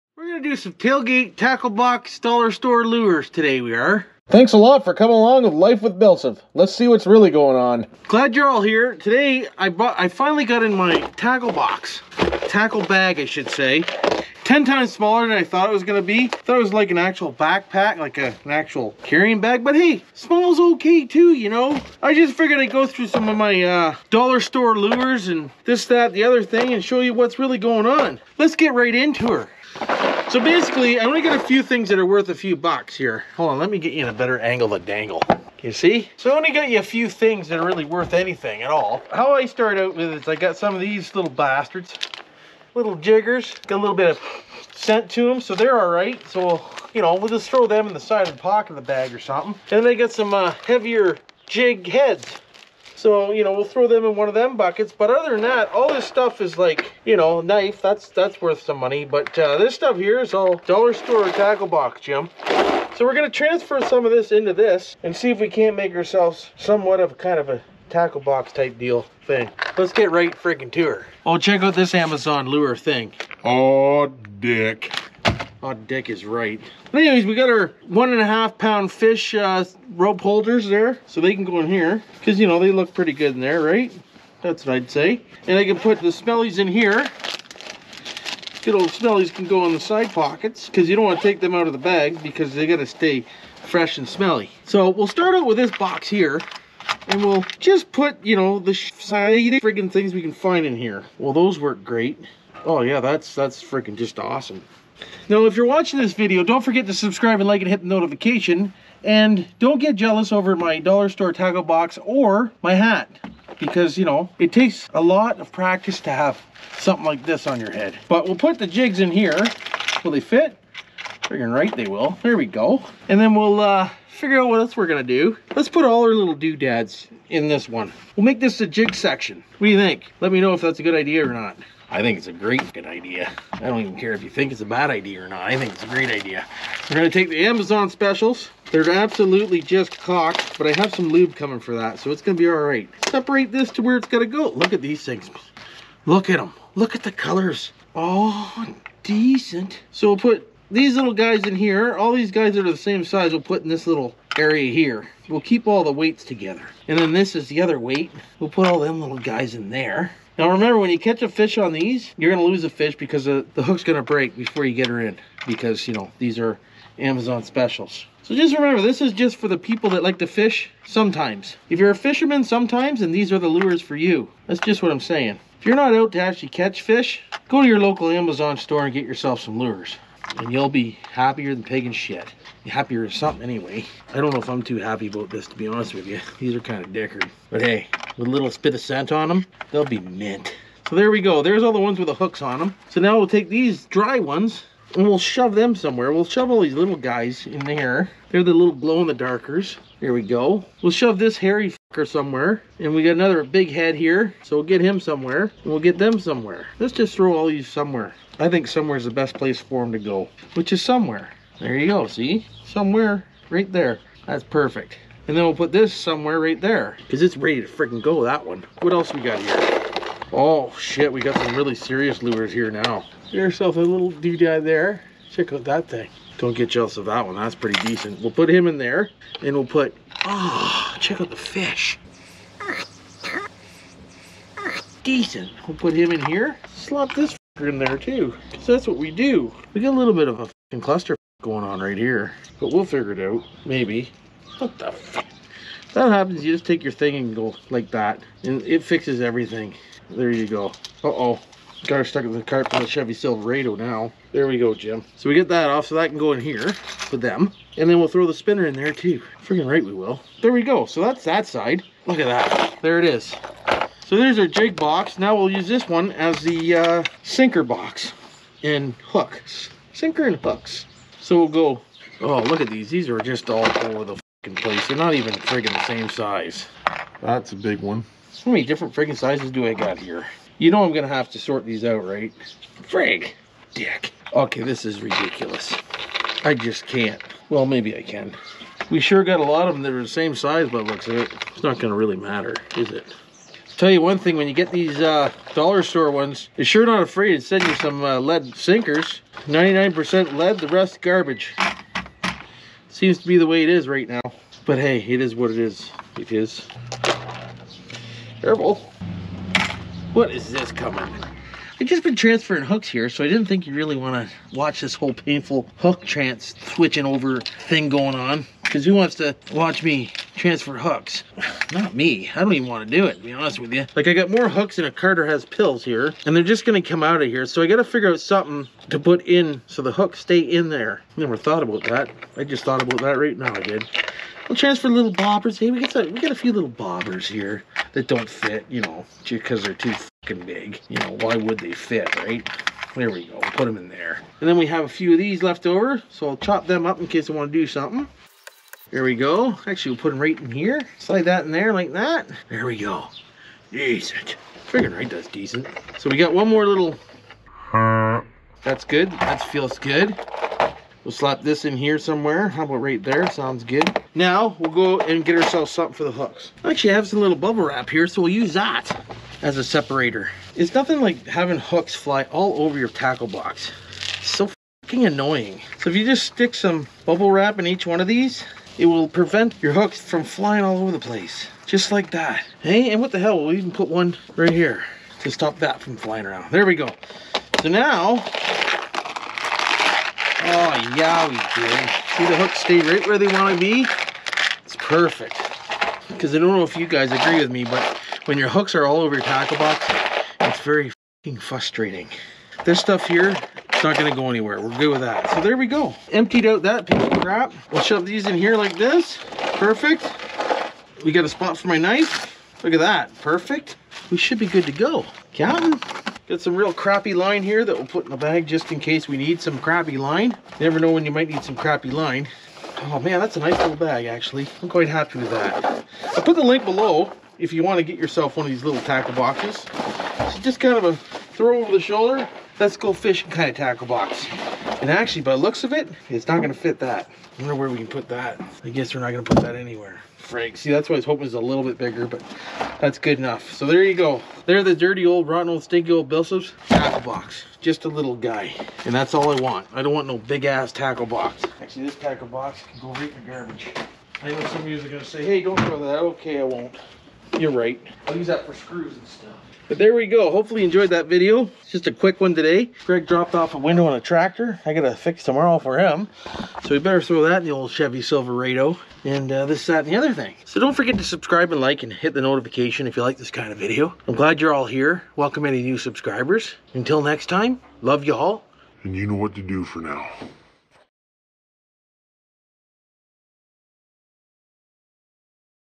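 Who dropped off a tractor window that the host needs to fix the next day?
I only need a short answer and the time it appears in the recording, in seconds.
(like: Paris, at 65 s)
Greg, at 462 s.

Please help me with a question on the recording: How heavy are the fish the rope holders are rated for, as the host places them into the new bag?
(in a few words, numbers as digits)
1.5 pounds.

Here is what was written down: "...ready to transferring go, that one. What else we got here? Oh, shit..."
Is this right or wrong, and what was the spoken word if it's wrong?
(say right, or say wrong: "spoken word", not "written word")
wrong: "freaking", not "transferring".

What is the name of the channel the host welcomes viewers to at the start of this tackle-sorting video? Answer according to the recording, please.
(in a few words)
Life with BillSiff.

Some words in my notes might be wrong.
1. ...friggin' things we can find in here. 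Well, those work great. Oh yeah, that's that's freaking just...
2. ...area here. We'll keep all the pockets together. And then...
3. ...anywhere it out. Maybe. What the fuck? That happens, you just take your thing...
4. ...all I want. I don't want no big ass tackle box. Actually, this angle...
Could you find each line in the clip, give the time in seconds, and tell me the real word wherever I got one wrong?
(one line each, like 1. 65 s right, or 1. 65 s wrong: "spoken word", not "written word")
1. 99 s right
2. 154 s wrong: "weights", not "pockets"
3. 242 s wrong: "figure", not "anywhere"
4. 449 s wrong: "tackle", not "angle".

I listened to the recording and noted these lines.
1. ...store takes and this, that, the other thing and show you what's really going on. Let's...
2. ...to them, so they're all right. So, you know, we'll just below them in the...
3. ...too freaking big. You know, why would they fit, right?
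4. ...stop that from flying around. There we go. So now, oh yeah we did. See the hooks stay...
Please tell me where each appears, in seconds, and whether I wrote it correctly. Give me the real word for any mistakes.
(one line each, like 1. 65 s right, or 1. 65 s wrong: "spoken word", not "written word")
1. 24 s wrong: "lures", not "takes"
2. 45 s wrong: "throw", not "below"
3. 339 s wrong: "fucking", not "freaking"
4. 385 s right.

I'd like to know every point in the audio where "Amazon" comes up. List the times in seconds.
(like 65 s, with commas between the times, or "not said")
71 s, 137 s, 166 s, 178 s.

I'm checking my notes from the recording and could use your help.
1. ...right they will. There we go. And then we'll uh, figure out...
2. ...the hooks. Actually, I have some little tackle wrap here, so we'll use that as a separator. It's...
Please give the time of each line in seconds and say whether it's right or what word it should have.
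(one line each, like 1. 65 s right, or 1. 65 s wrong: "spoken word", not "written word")
1. 121 s right
2. 366 s wrong: "bubble", not "tackle".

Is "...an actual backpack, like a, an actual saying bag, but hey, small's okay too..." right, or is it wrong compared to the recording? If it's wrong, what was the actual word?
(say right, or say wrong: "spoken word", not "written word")
wrong: "carrying", not "saying".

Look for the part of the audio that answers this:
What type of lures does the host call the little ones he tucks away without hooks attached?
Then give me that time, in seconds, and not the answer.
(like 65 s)
198 s.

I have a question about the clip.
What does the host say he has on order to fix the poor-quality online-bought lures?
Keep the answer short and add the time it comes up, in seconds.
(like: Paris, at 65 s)
Lube, at 141 s.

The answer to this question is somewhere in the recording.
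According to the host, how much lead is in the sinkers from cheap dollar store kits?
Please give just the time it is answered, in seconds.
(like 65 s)
299 s.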